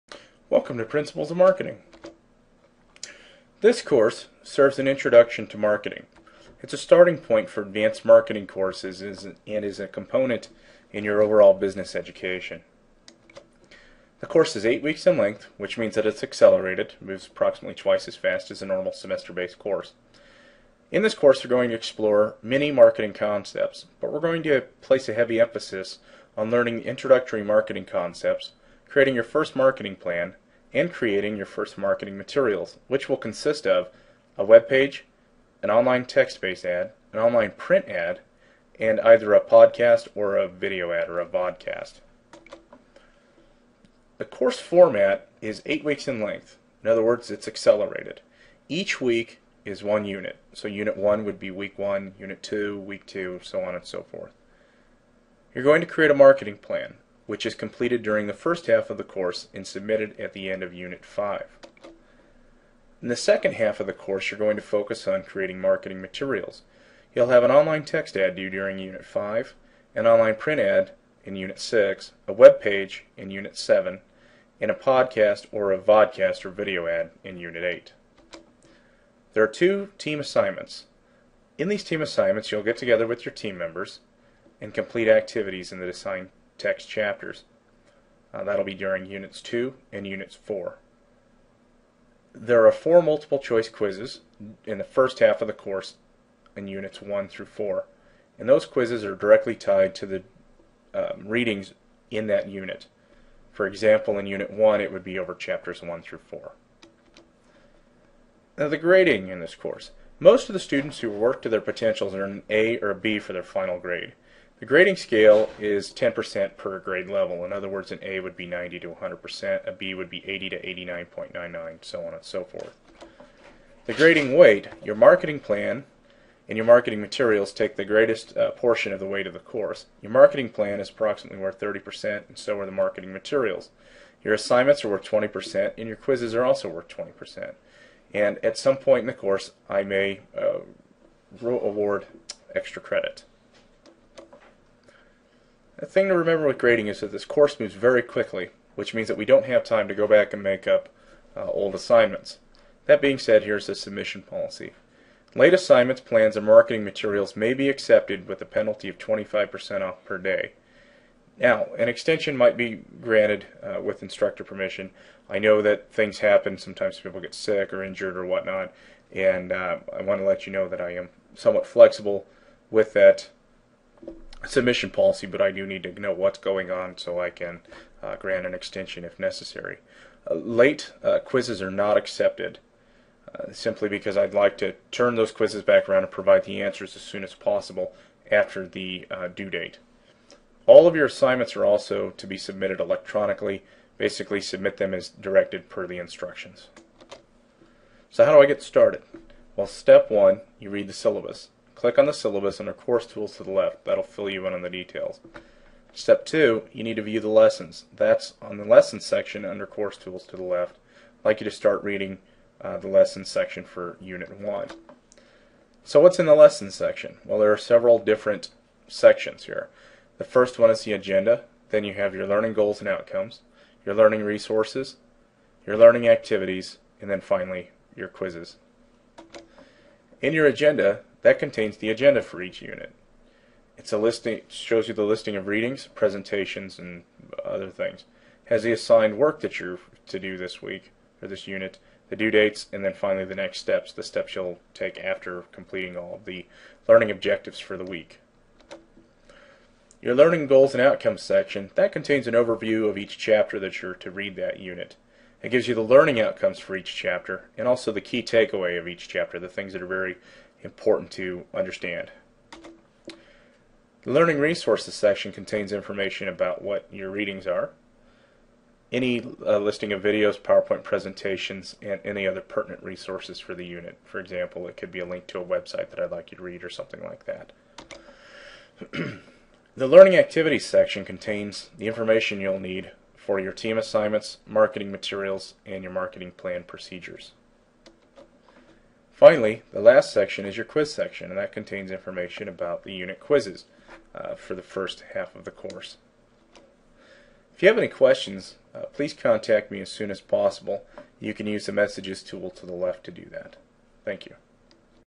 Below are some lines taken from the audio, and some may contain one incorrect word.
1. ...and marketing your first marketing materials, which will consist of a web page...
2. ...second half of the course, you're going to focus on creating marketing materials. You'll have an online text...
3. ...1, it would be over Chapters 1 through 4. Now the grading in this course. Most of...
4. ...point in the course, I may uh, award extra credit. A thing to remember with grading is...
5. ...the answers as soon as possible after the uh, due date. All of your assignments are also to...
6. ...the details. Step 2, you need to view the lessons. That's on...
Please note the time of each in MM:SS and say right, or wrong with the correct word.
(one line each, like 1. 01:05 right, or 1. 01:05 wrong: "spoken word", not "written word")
1. 00:30 wrong: "creating", not "marketing"
2. 01:03 right
3. 01:44 right
4. 02:18 right
5. 03:06 right
6. 03:24 right.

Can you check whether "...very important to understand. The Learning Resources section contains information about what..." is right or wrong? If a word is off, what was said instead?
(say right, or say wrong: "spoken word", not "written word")
right.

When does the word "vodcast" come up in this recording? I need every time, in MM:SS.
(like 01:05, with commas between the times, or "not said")
00:41, 01:15.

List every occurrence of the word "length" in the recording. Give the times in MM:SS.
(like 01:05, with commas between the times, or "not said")
00:15, 00:46.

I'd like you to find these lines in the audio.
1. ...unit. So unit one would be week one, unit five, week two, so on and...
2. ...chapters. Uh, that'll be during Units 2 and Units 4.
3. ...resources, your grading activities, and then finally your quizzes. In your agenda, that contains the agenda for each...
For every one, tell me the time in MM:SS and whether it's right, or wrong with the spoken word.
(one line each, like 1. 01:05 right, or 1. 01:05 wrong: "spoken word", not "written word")
1. 00:50 wrong: "two", not "five"
2. 01:26 right
3. 03:44 wrong: "learning", not "grading".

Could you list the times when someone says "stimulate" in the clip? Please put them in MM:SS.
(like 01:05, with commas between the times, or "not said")
not said.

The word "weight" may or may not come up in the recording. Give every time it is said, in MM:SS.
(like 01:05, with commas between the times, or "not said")
02:04, 02:09.